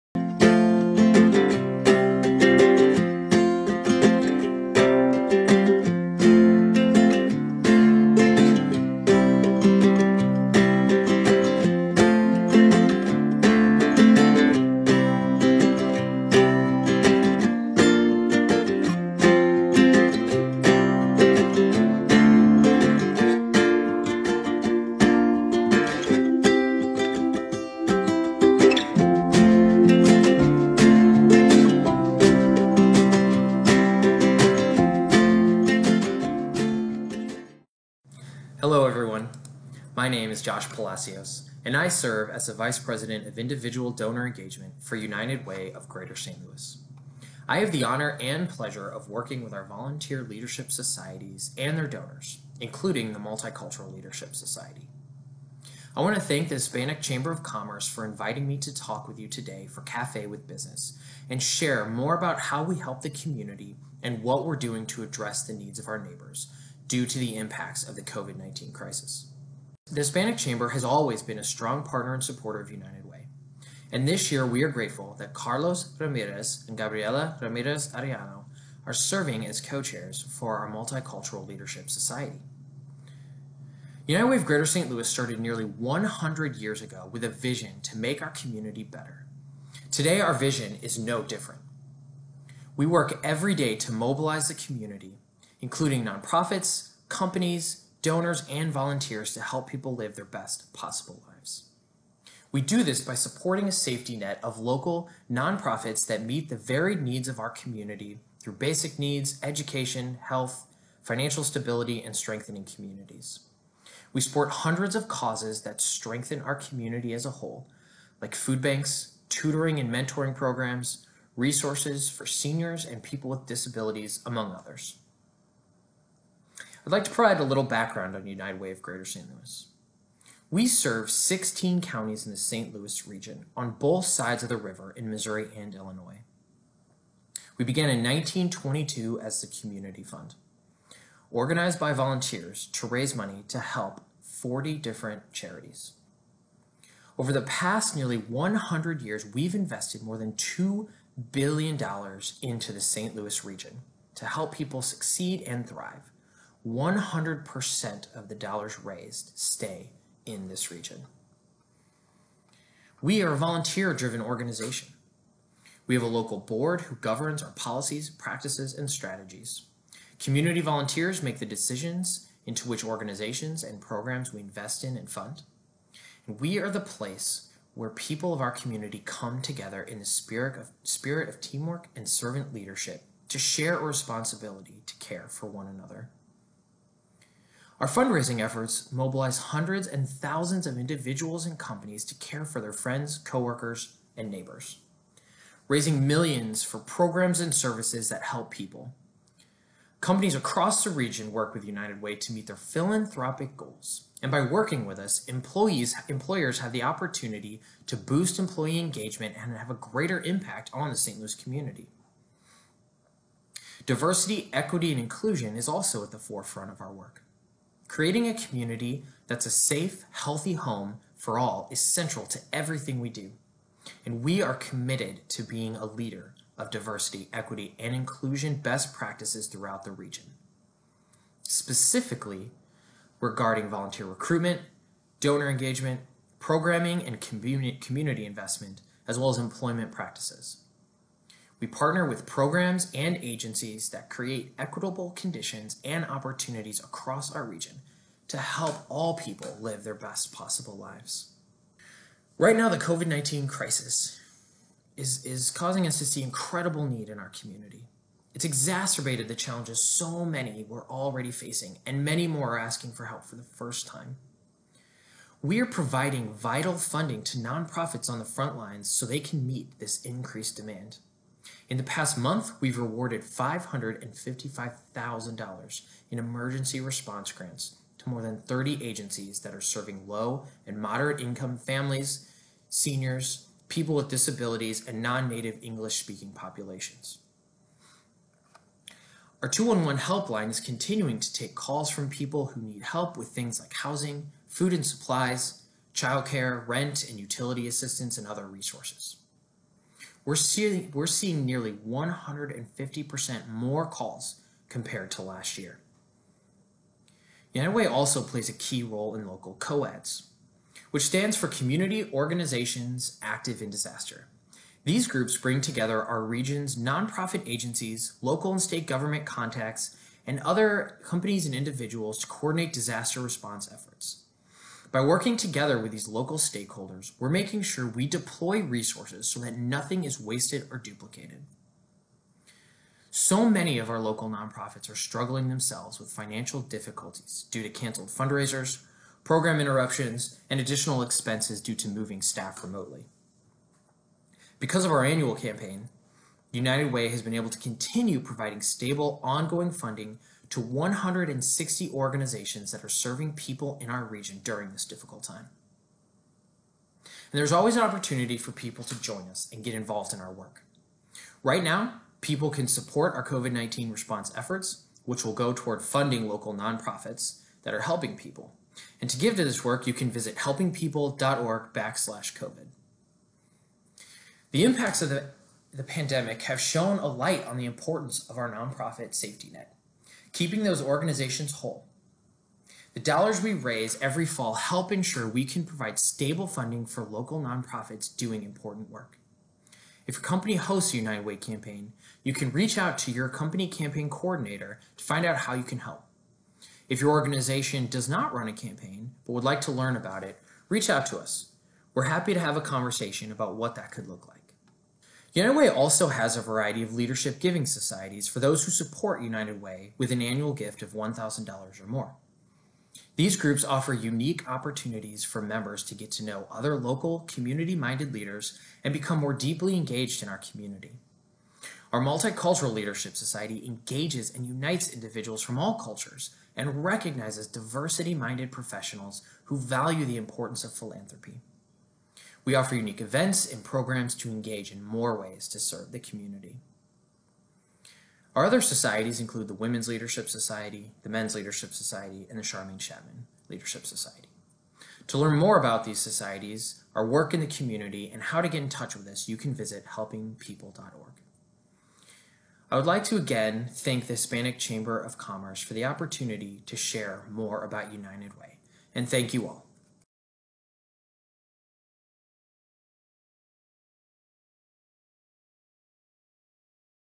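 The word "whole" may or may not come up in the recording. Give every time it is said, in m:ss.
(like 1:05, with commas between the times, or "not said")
1:57, 6:21.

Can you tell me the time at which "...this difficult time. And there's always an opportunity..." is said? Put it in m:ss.
5:54.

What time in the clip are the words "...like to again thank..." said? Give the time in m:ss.
7:32.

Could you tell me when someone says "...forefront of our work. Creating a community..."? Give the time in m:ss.
3:36.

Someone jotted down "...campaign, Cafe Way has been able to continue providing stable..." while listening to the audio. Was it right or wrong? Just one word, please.
wrong.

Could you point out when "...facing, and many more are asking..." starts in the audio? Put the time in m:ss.
4:21.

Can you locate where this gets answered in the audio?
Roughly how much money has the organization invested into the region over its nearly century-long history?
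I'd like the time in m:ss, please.
2:30.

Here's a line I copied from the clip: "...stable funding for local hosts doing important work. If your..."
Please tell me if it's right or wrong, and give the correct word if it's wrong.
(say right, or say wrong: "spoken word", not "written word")
wrong: "nonprofits", not "hosts".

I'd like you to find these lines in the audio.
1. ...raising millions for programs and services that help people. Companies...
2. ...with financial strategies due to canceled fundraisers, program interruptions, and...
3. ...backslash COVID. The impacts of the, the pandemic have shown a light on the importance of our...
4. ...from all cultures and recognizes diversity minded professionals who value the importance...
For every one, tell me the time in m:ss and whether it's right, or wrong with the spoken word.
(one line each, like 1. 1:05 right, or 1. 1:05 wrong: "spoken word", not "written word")
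1. 3:15 right
2. 5:35 wrong: "difficulties", not "strategies"
3. 6:11 right
4. 7:05 right.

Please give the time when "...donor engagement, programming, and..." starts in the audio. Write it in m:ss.
3:55.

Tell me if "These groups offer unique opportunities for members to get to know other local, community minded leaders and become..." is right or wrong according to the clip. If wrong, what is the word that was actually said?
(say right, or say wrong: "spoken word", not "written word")
right.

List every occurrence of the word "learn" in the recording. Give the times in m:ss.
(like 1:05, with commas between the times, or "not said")
6:39, 7:25.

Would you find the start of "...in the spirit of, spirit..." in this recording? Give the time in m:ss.
2:59.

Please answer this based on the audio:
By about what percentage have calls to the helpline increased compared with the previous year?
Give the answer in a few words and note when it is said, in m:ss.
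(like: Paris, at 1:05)
150%, at 5:01.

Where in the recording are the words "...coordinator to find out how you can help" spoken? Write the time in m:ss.
6:34.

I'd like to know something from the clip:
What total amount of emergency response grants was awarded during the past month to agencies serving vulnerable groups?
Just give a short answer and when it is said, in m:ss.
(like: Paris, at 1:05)
$555,000, at 4:33.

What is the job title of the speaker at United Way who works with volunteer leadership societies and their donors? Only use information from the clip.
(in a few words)
Vice President of Individual Donor Engagement.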